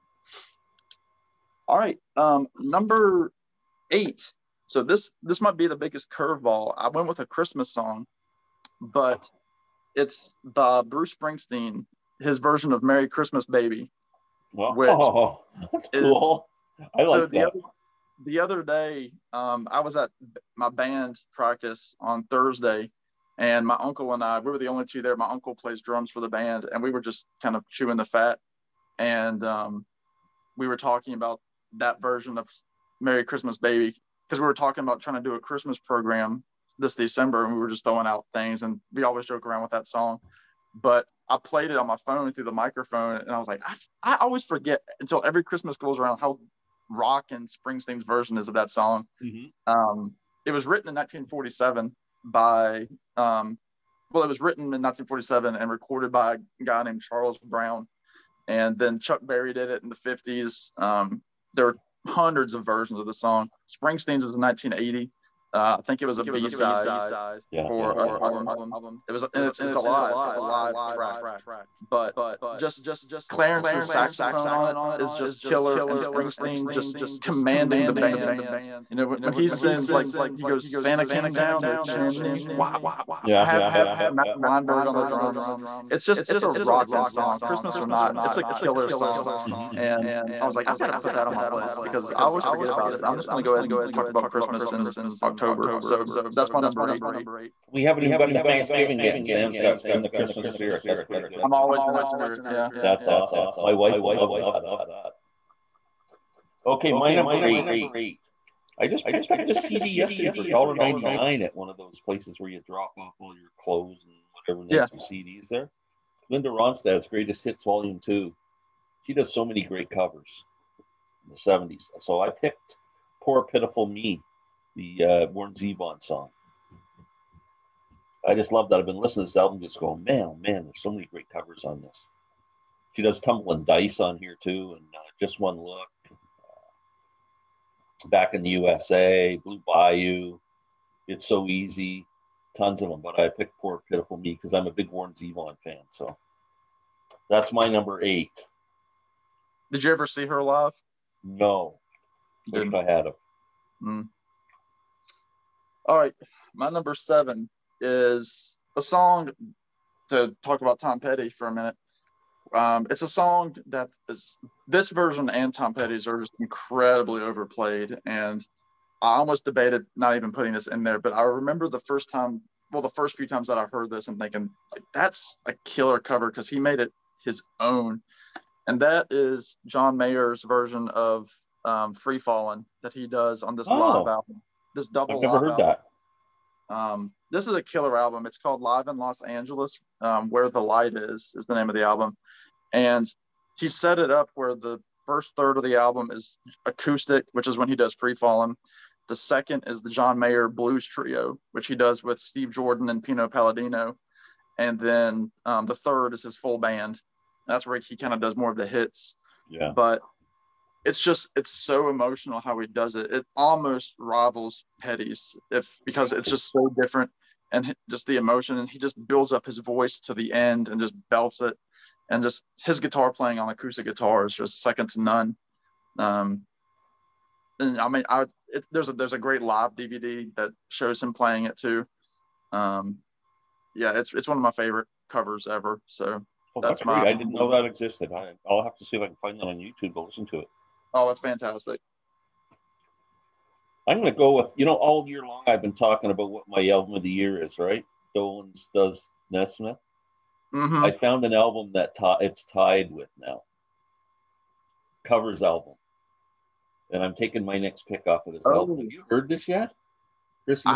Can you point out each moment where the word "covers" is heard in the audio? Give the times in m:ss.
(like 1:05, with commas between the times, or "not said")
1:59, 2:11, 2:55, 3:55, 4:15.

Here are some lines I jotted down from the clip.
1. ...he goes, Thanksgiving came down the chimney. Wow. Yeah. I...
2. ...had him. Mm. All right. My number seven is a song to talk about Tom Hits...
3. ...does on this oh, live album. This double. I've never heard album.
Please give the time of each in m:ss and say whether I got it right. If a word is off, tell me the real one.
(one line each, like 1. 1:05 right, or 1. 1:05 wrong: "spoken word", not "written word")
1. 1:20 wrong: "Santa", not "Thanksgiving"
2. 2:32 wrong: "Petty", not "Hits"
3. 3:03 right.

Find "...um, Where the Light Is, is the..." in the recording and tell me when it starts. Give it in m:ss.
3:09.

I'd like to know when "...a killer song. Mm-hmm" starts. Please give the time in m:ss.
1:28.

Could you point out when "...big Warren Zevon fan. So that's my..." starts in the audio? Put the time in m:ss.
2:24.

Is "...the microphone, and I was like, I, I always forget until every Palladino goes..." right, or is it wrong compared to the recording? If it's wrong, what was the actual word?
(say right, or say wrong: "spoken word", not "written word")
wrong: "Christmas", not "Palladino".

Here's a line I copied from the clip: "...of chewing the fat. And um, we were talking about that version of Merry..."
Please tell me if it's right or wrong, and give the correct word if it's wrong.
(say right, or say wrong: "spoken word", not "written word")
right.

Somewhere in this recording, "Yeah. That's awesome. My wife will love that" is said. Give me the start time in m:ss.
1:42.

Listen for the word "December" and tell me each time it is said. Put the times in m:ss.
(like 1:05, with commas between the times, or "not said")
0:36.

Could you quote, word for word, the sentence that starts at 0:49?
Um, it was written in 1947 by, um, well, it was written in 1947 and recorded by a guy named Charles Brown.